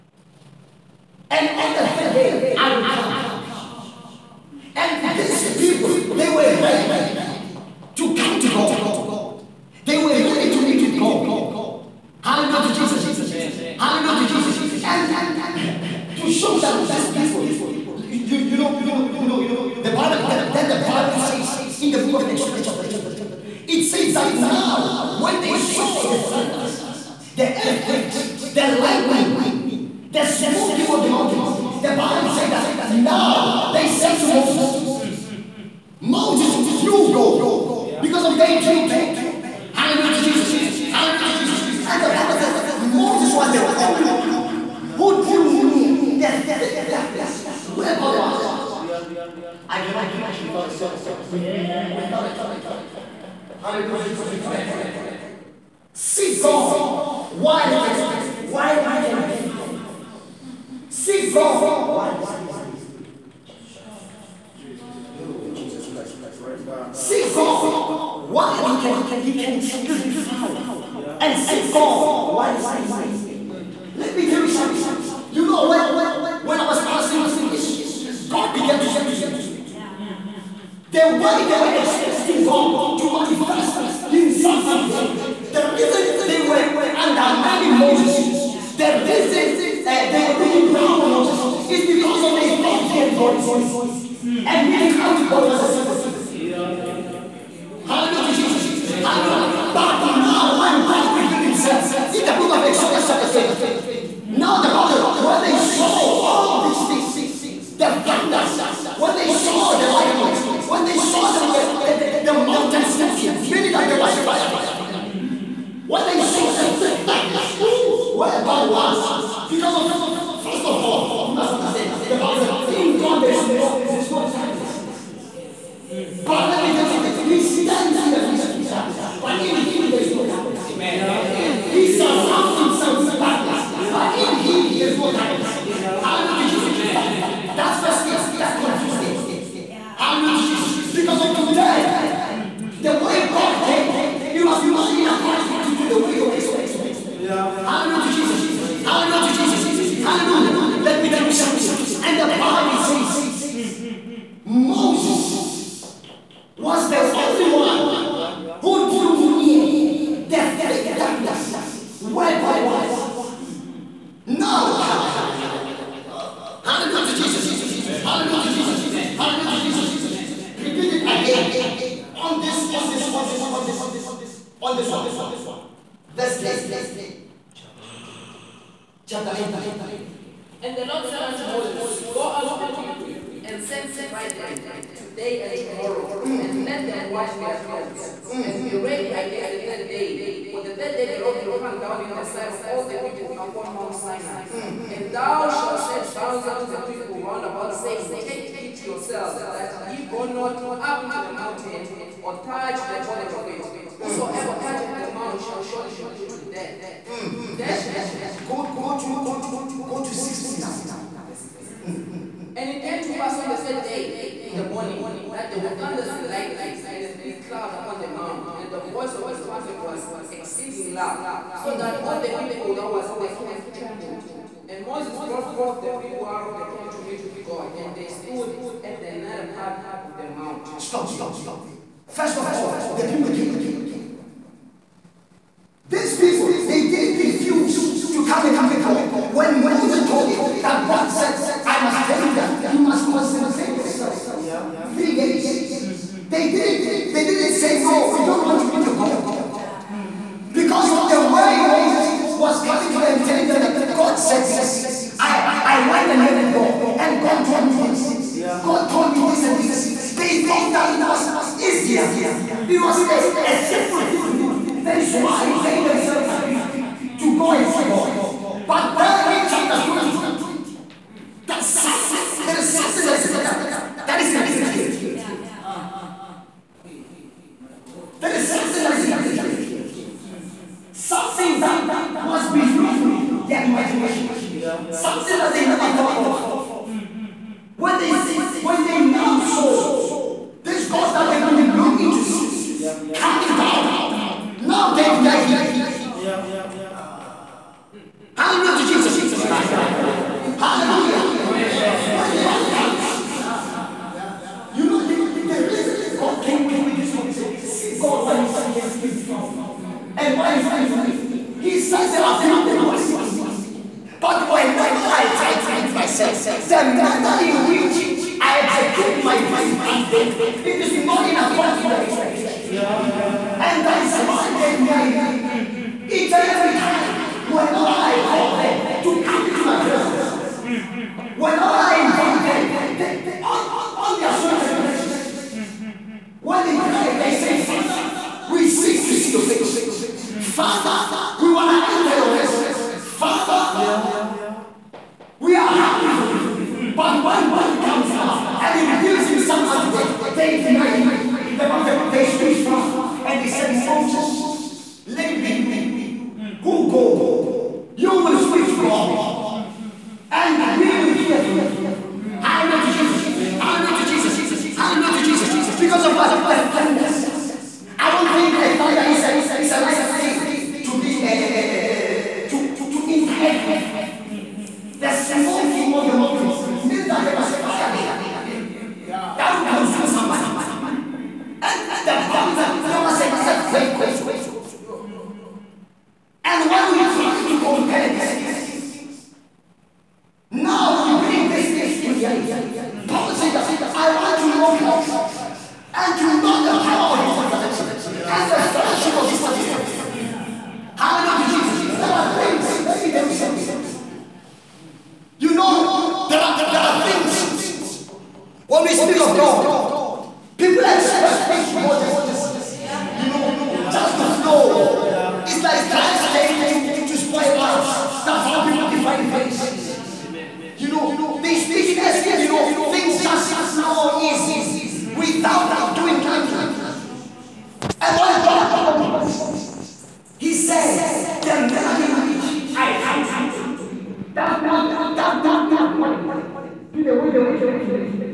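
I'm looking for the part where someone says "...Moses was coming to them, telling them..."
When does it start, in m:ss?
4:11.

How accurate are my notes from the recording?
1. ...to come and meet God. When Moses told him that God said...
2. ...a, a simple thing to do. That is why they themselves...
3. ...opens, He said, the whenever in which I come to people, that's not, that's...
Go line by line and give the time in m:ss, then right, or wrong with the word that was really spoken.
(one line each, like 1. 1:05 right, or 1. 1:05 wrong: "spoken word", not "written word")
1. 3:58 right
2. 4:23 right
3. 7:08 wrong: "manner", not "whenever".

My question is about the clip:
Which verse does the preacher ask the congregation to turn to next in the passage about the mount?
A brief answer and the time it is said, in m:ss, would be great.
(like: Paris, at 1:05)
16, at 3:31.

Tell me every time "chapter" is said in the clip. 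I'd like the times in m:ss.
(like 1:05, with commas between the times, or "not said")
0:22, 1:43, 4:29.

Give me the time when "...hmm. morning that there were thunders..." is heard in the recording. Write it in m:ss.
3:34.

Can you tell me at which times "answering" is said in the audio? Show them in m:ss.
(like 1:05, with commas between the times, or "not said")
not said.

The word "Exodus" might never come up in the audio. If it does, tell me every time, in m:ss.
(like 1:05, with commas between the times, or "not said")
0:22, 1:42.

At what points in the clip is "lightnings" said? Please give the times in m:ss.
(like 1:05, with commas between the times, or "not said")
0:28, 1:49, 3:36.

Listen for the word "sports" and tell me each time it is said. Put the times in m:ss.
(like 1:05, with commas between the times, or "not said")
not said.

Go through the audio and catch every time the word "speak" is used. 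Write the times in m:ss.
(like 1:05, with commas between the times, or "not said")
1:18, 5:58, 6:48.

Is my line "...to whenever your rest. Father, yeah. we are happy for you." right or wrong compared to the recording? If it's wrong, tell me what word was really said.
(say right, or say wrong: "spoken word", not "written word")
wrong: "enter", not "whenever".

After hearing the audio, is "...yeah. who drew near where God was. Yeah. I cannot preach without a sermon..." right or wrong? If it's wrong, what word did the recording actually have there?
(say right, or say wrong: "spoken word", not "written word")
right.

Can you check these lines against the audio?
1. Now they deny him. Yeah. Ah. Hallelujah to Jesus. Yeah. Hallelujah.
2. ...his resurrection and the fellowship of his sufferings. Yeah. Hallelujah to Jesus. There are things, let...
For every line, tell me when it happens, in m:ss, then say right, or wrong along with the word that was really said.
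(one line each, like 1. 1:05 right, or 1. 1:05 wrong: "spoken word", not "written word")
1. 4:54 right
2. 6:37 right.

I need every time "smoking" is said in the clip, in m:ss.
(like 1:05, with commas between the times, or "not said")
0:30, 1:52.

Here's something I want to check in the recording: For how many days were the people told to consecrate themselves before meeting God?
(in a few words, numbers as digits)
3.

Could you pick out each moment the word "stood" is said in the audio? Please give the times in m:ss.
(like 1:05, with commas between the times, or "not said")
3:48, 5:52.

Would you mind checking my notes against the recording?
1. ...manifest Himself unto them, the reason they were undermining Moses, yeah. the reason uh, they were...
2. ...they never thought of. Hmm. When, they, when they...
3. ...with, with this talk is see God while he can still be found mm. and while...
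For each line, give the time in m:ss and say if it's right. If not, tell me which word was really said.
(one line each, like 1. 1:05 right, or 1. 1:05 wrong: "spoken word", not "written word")
1. 1:23 right
2. 4:45 right
3. 5:06 right.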